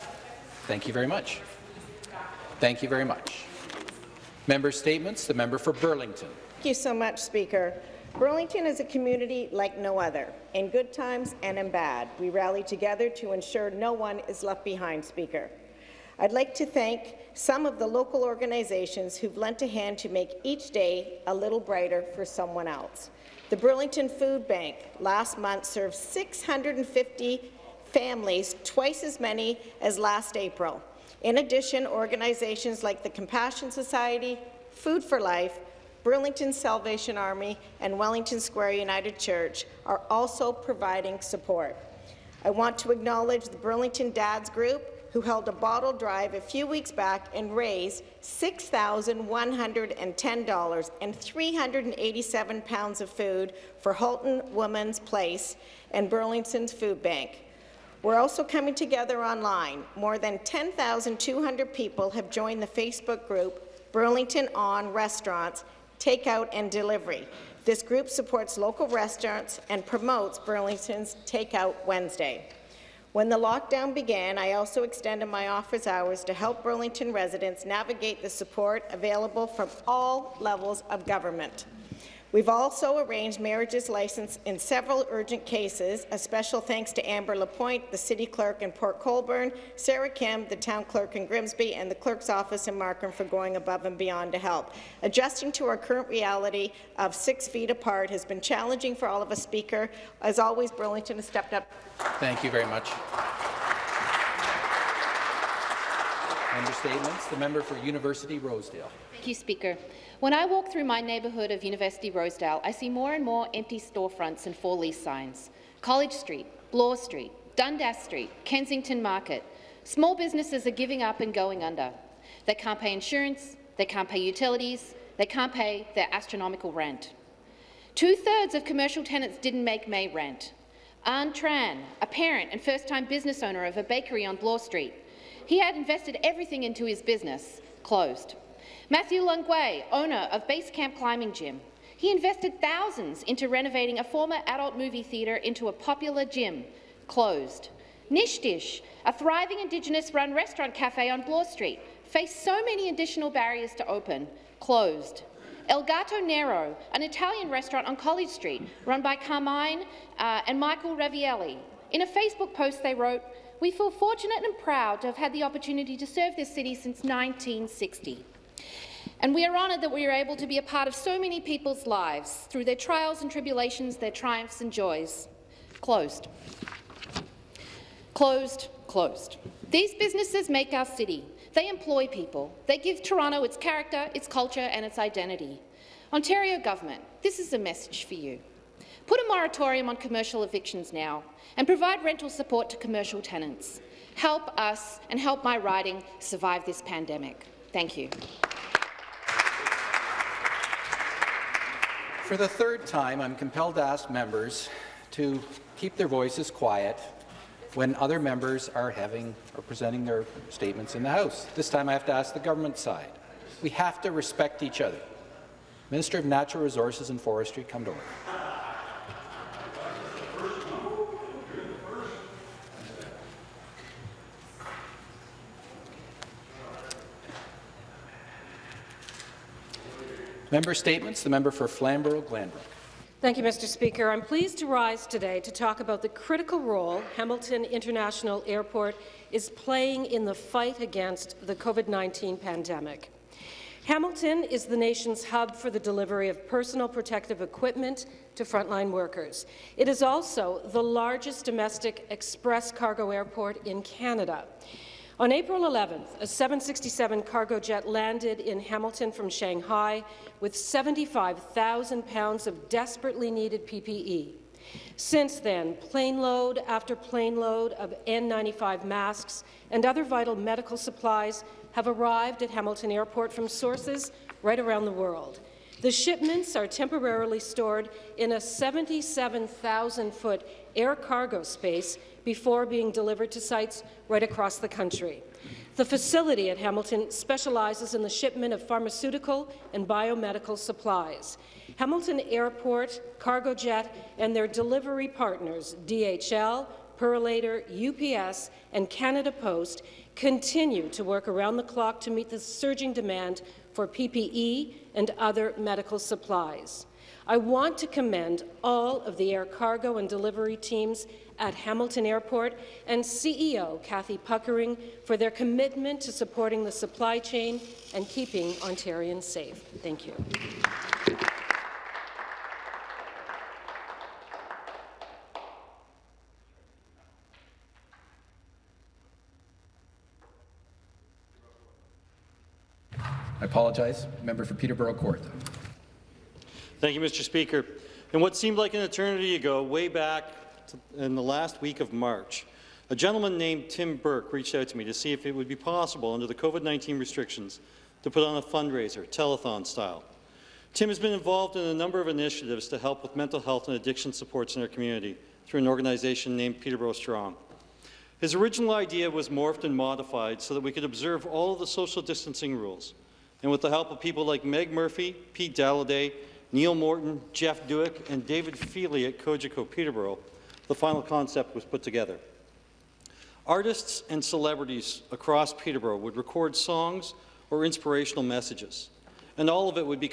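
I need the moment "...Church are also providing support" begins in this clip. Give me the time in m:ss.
0:39.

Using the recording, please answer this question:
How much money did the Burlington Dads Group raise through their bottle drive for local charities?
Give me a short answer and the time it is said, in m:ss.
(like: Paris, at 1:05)
$6,110, at 0:48.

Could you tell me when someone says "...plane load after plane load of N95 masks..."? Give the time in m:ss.
4:25.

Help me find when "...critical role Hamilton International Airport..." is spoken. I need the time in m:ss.
3:56.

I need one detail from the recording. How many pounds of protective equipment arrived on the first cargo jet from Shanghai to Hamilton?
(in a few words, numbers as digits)
75,000.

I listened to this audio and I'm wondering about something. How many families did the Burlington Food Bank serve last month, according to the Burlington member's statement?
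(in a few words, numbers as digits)
650.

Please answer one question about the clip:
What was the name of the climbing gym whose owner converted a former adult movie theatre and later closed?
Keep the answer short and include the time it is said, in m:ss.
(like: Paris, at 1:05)
Basecamp Climbing Gym, at 2:20.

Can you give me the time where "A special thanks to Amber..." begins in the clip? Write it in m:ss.
1:26.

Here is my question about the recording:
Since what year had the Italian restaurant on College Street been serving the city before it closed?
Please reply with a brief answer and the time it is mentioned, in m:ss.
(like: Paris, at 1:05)
1960, at 2:47.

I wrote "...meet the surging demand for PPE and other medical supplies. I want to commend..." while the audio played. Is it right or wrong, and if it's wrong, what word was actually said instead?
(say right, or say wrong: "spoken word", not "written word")
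right.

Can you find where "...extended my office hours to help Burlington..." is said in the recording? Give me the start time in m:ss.
1:14.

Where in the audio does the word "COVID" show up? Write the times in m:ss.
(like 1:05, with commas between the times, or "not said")
4:01, 5:46.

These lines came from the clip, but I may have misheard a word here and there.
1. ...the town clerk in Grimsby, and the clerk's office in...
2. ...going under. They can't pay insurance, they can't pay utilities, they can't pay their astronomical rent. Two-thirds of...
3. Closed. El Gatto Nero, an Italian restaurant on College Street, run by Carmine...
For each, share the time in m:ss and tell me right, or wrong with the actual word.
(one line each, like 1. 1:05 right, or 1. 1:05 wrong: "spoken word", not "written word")
1. 1:30 right
2. 2:01 right
3. 2:34 right.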